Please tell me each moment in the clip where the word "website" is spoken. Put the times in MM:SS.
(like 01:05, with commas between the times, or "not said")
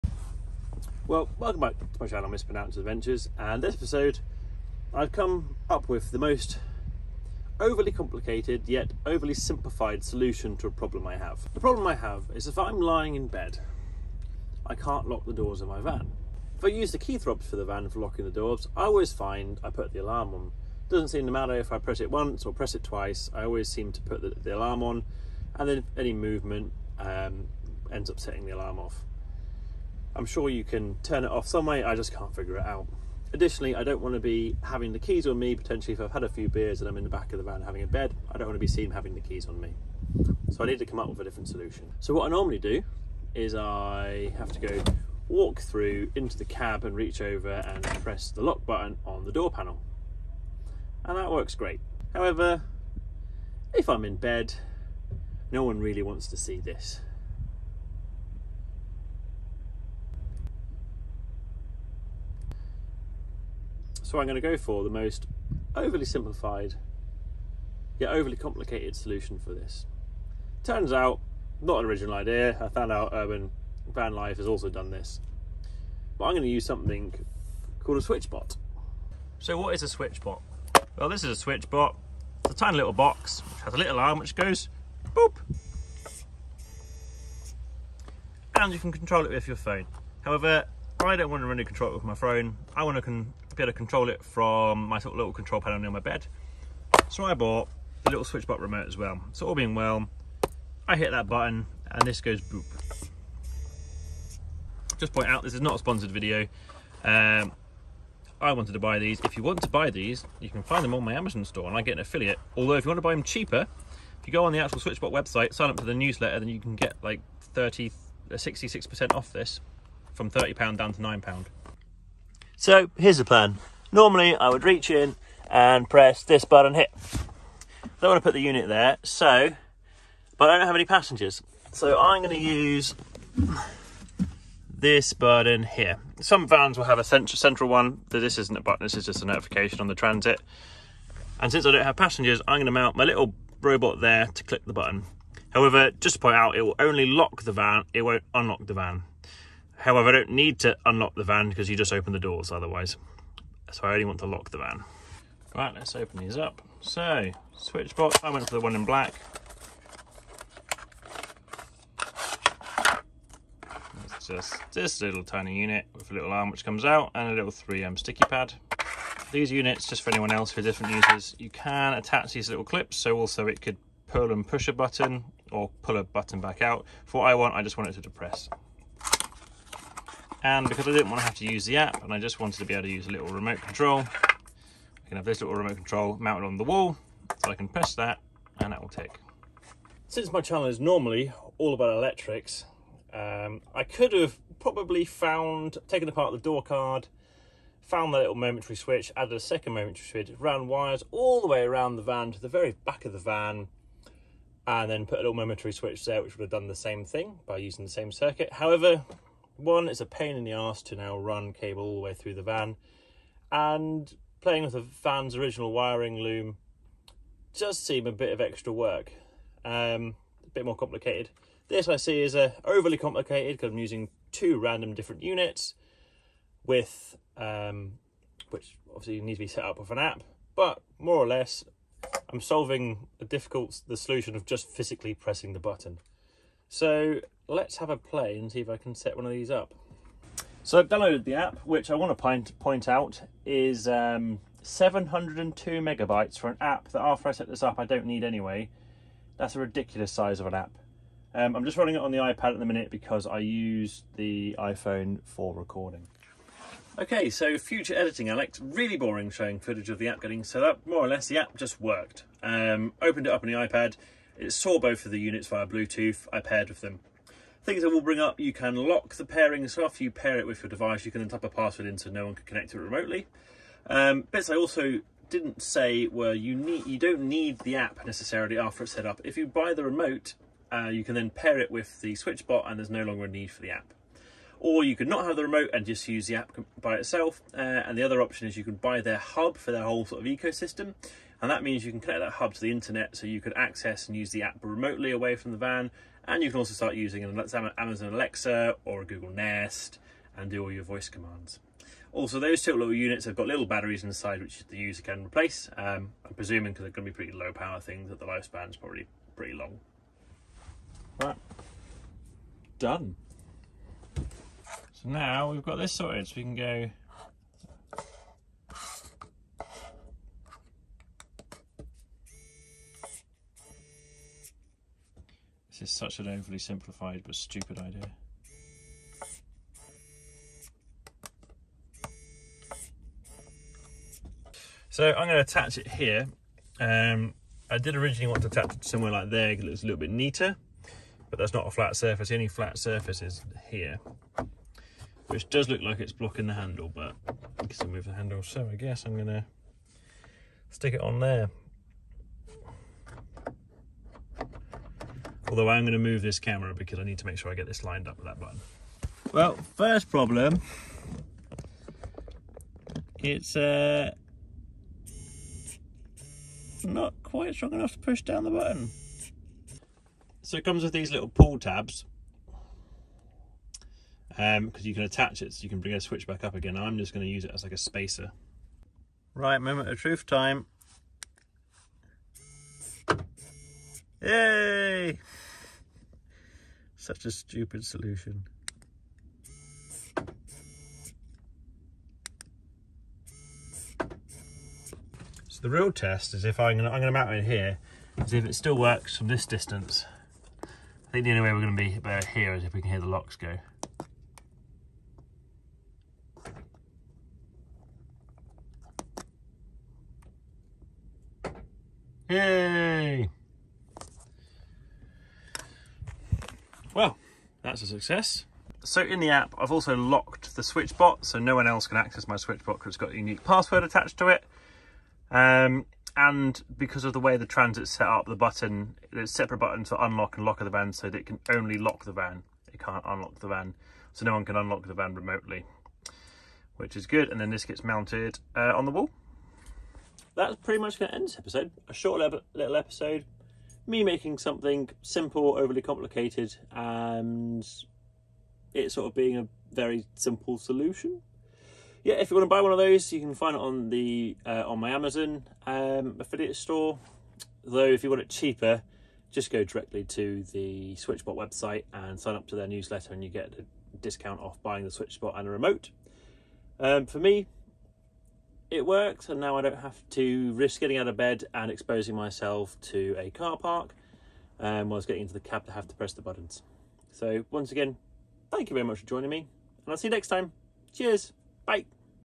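01:55, 07:41.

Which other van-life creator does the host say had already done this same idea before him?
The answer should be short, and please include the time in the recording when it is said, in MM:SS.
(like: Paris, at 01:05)
Urban Van Life, at 01:13.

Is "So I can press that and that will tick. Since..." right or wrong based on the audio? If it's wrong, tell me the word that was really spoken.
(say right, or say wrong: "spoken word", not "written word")
right.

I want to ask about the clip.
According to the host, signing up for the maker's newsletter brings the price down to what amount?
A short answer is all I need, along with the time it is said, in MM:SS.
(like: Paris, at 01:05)
£9, at 02:01.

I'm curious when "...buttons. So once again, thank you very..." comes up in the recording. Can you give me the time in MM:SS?
07:56.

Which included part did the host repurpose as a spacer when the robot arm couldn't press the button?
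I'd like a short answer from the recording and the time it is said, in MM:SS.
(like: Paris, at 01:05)
pull tabs, at 06:11.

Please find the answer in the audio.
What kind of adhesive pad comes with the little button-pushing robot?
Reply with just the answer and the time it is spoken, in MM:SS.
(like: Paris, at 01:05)
3M sticky pad, at 02:47.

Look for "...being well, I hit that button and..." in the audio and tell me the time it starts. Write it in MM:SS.
01:39.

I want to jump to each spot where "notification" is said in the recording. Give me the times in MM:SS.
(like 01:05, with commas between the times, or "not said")
02:19.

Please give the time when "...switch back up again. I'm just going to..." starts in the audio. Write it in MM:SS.
06:15.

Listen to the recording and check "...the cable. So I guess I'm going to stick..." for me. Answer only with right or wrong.
wrong.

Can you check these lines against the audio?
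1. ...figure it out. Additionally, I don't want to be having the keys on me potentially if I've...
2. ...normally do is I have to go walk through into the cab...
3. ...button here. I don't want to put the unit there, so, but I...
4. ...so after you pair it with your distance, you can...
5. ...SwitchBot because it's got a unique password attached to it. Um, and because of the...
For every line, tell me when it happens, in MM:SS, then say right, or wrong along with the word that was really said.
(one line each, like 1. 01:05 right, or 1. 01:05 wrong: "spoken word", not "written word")
1. 00:32 right
2. 00:42 right
3. 02:06 right
4. 04:29 wrong: "device", not "distance"
5. 07:02 right.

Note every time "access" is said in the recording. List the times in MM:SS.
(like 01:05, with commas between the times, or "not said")
04:53, 07:01.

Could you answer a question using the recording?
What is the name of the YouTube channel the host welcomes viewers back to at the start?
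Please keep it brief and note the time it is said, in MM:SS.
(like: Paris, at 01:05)
Mispronounced Adventures, at 00:02.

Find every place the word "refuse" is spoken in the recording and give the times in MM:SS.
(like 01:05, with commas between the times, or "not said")
not said.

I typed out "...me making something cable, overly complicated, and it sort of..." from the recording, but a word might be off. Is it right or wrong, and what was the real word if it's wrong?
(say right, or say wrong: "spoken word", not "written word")
wrong: "simple", not "cable".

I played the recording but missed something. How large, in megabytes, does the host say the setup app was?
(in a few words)
702.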